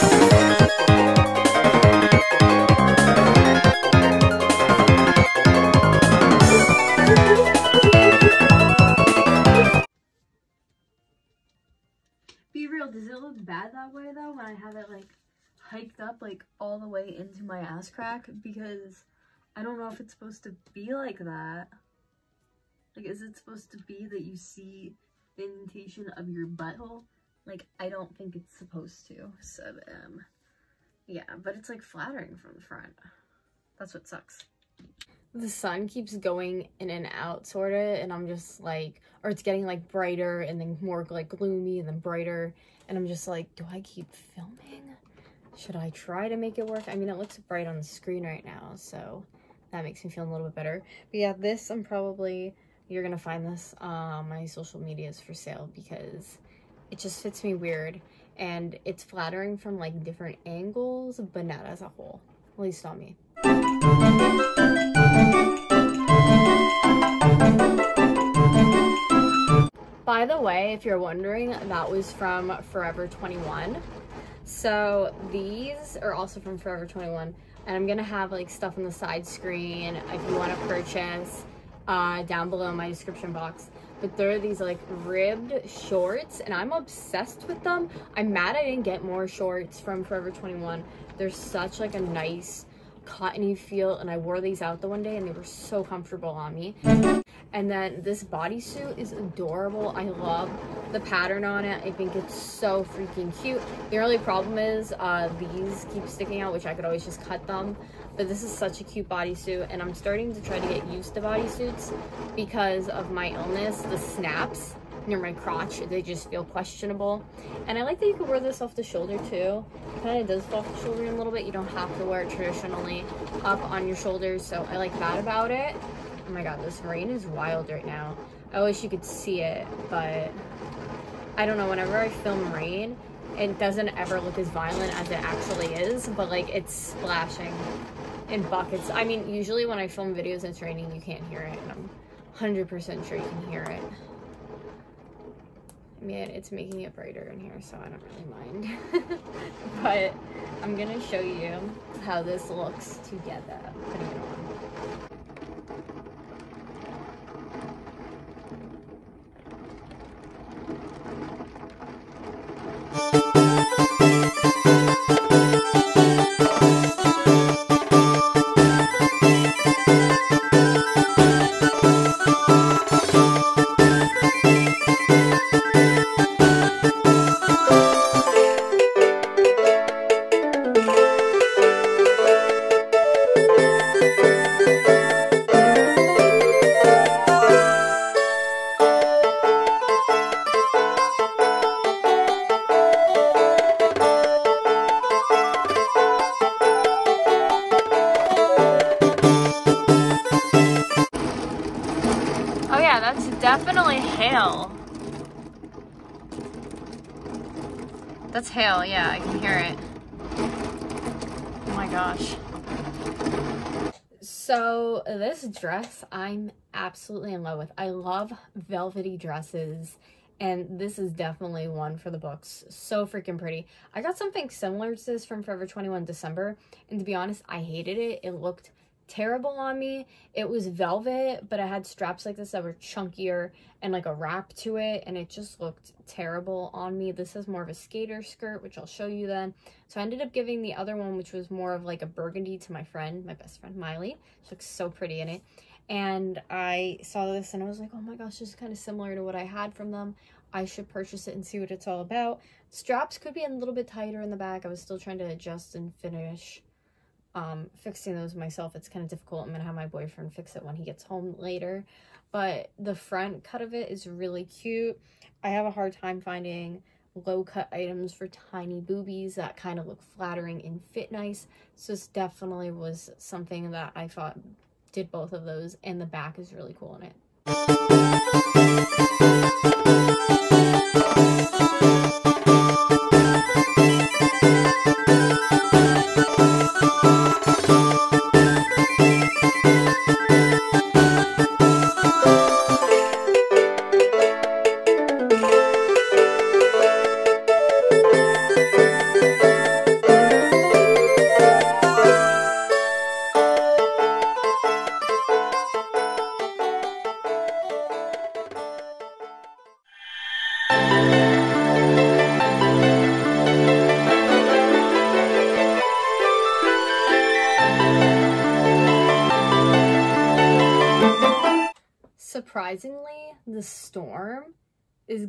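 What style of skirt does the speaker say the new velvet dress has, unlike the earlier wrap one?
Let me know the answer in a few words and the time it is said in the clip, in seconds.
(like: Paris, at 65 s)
skater skirt, at 237 s.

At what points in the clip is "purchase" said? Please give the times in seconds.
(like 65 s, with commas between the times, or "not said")
80 s, 250 s.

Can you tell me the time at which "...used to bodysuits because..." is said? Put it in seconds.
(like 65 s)
110 s.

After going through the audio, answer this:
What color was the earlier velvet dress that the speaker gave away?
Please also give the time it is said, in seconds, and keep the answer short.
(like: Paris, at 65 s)
burgundy, at 242 s.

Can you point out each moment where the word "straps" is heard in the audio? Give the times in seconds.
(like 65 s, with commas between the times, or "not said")
231 s, 252 s.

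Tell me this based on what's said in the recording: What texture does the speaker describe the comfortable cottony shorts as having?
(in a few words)
ribbed.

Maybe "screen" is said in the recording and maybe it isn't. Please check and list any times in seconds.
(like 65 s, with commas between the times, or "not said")
47 s, 79 s.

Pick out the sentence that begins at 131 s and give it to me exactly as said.
Whenever I film rain, it doesn't ever look as violent as it actually is, but like it's splashing in buckets.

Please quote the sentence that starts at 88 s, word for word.
I'm mad I didn't get more shorts from Forever 21.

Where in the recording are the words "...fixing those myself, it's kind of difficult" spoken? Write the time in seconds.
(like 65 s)
257 s.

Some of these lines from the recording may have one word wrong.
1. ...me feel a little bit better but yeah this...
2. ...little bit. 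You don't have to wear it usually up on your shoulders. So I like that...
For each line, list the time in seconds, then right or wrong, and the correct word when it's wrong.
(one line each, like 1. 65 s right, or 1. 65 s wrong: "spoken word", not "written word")
1. 50 s right
2. 121 s wrong: "traditionally", not "usually".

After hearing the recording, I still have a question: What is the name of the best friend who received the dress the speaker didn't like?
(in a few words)
Miley.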